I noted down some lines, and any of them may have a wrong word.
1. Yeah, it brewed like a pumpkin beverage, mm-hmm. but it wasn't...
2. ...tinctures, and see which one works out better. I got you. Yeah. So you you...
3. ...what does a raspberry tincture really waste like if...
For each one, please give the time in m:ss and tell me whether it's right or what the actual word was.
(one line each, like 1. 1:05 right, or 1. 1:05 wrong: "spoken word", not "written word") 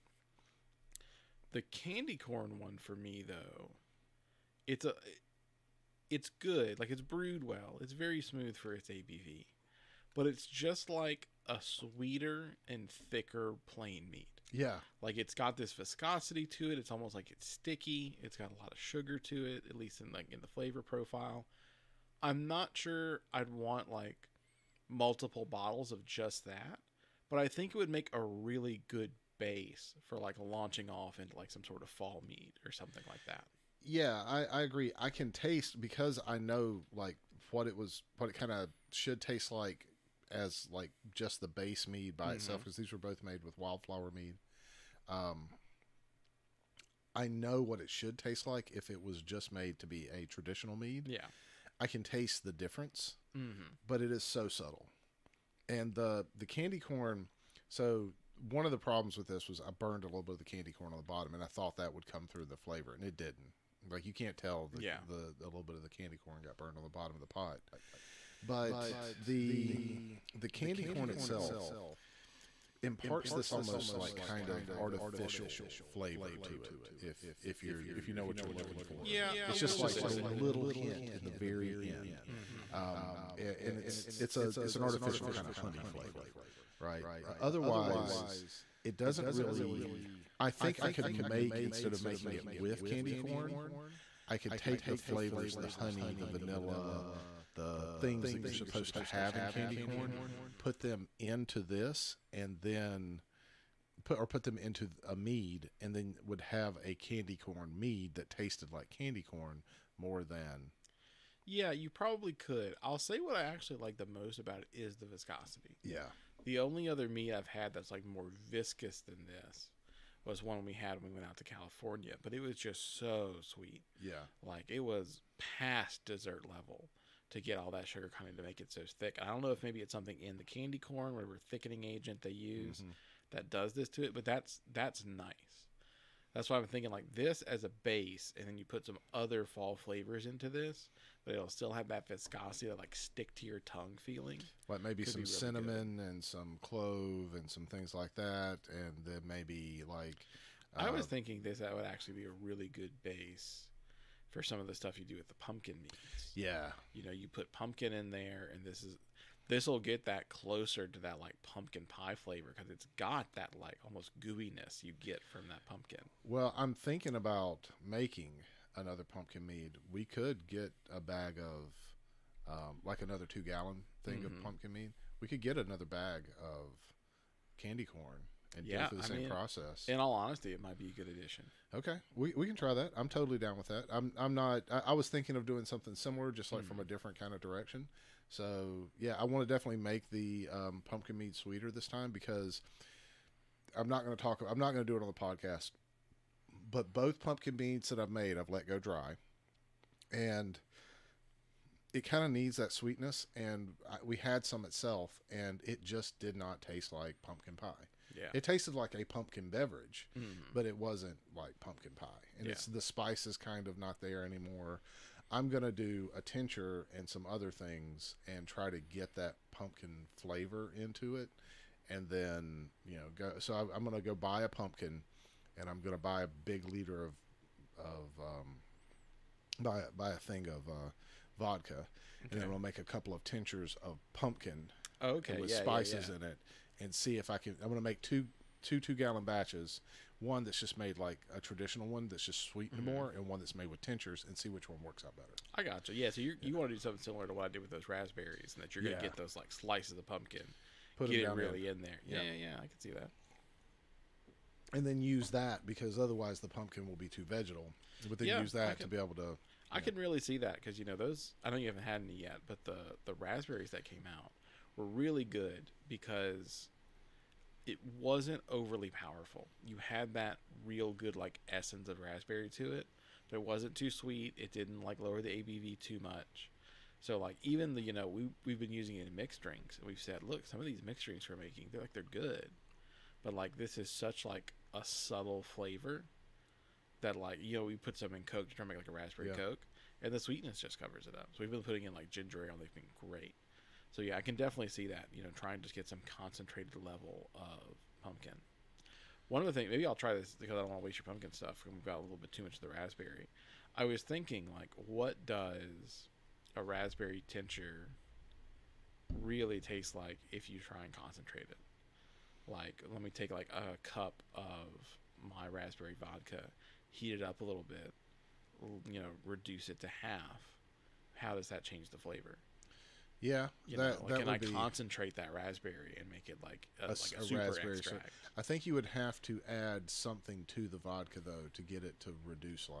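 1. 3:28 wrong: "tasted", not "brewed"
2. 4:03 right
3. 5:04 wrong: "taste", not "waste".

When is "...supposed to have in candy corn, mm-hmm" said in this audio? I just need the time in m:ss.
1:38.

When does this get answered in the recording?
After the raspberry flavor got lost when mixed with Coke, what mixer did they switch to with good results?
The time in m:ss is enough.
4:52.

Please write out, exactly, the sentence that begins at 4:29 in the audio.
You had that real good like essence of raspberry to it, but it wasn't too sweet.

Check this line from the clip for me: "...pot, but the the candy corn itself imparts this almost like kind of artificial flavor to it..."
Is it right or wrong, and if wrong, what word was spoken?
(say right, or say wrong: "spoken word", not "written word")
right.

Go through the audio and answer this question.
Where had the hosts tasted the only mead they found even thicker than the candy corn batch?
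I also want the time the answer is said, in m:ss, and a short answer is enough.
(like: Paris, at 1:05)
California, at 2:01.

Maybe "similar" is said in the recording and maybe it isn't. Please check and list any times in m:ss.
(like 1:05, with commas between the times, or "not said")
3:05, 4:07.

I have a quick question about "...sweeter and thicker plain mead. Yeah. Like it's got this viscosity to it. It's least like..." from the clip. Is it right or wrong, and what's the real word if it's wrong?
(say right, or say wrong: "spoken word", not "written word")
wrong: "almost", not "least".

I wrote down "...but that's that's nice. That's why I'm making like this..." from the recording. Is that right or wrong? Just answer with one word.
wrong.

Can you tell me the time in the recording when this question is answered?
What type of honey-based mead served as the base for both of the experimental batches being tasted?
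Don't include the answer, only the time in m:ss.
0:43.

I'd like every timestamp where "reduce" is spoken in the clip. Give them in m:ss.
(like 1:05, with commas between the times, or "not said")
5:19, 5:32.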